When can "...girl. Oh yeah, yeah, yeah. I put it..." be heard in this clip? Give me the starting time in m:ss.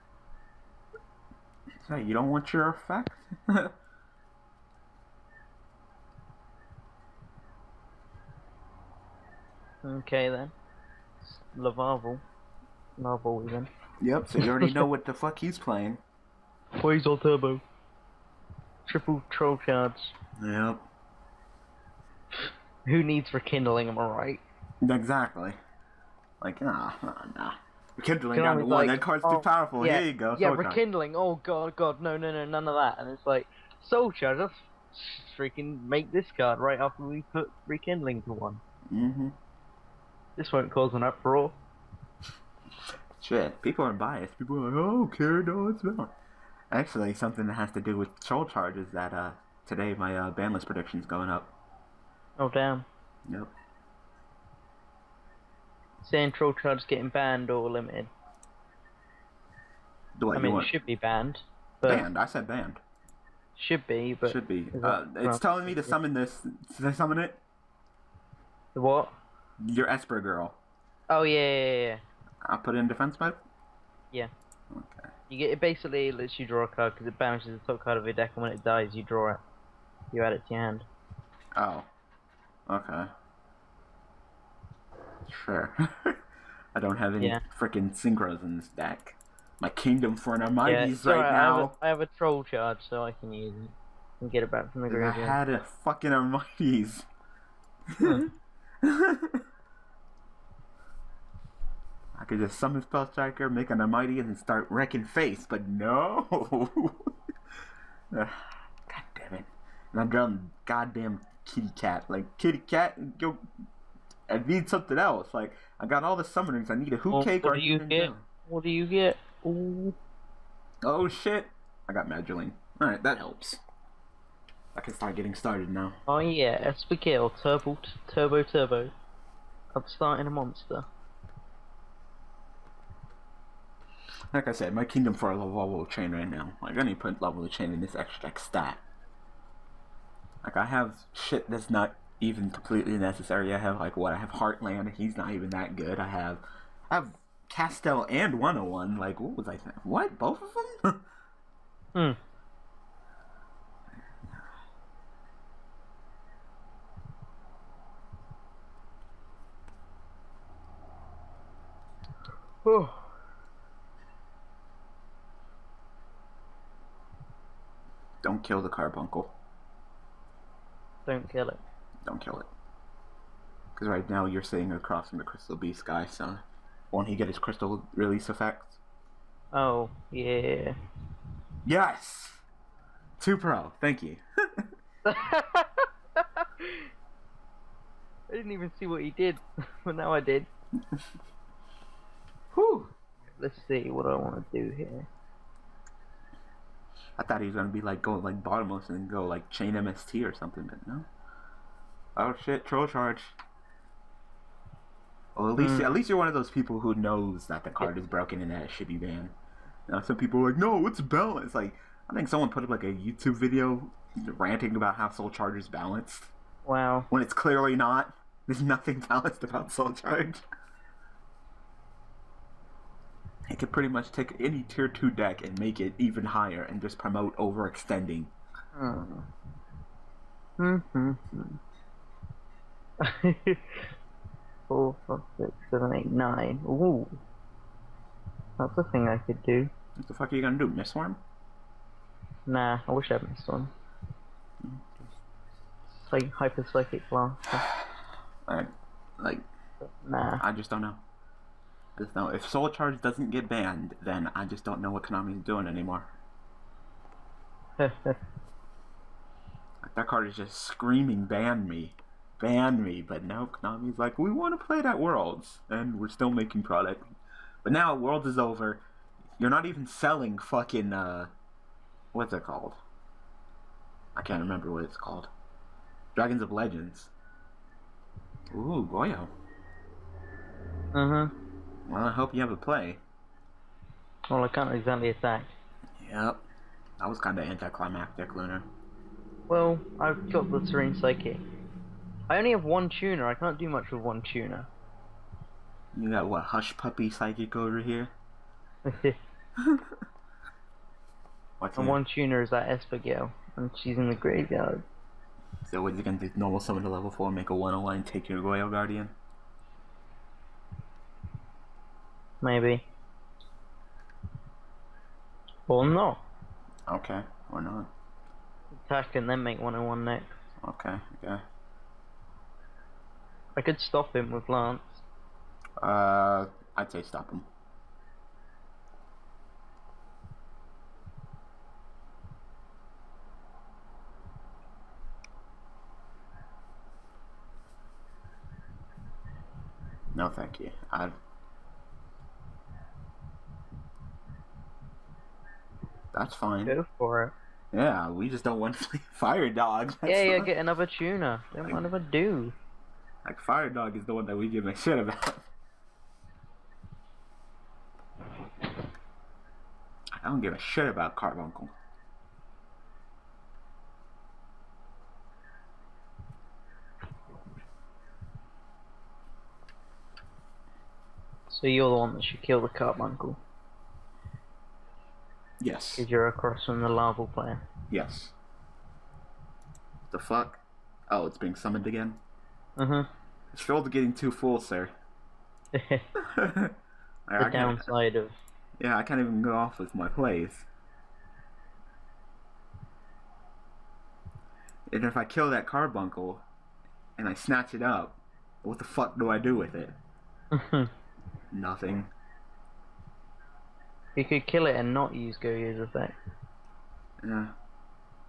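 1:10.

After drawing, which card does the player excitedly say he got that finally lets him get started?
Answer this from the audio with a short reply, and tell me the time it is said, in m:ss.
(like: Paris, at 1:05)
Magdalene, at 2:02.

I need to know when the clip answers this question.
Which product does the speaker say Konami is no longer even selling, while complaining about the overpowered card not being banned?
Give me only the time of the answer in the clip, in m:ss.
4:36.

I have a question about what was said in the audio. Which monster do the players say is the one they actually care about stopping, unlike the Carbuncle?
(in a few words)
Fire Dog.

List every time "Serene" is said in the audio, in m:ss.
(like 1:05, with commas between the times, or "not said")
4:50.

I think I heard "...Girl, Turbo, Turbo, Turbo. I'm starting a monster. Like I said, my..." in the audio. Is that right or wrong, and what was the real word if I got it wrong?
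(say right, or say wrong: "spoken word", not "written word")
right.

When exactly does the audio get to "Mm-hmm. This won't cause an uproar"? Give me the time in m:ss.
0:38.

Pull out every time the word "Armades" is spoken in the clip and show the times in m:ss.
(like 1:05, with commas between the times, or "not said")
1:30, 1:36.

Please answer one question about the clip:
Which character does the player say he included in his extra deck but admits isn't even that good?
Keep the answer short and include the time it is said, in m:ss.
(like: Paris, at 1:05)
Heartland, at 2:24.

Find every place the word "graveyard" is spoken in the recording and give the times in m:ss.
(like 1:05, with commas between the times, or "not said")
1:34, 5:04.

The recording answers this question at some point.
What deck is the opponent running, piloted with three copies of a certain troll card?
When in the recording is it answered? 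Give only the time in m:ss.
0:16.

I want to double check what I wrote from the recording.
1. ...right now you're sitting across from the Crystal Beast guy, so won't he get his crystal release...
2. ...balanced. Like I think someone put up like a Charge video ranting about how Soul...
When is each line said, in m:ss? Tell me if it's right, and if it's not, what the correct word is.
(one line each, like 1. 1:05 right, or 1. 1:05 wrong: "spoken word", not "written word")
1. 2:53 right
2. 3:30 wrong: "YouTube", not "Charge".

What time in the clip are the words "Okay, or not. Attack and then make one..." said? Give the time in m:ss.
5:16.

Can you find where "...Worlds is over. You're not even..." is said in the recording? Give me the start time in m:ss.
4:27.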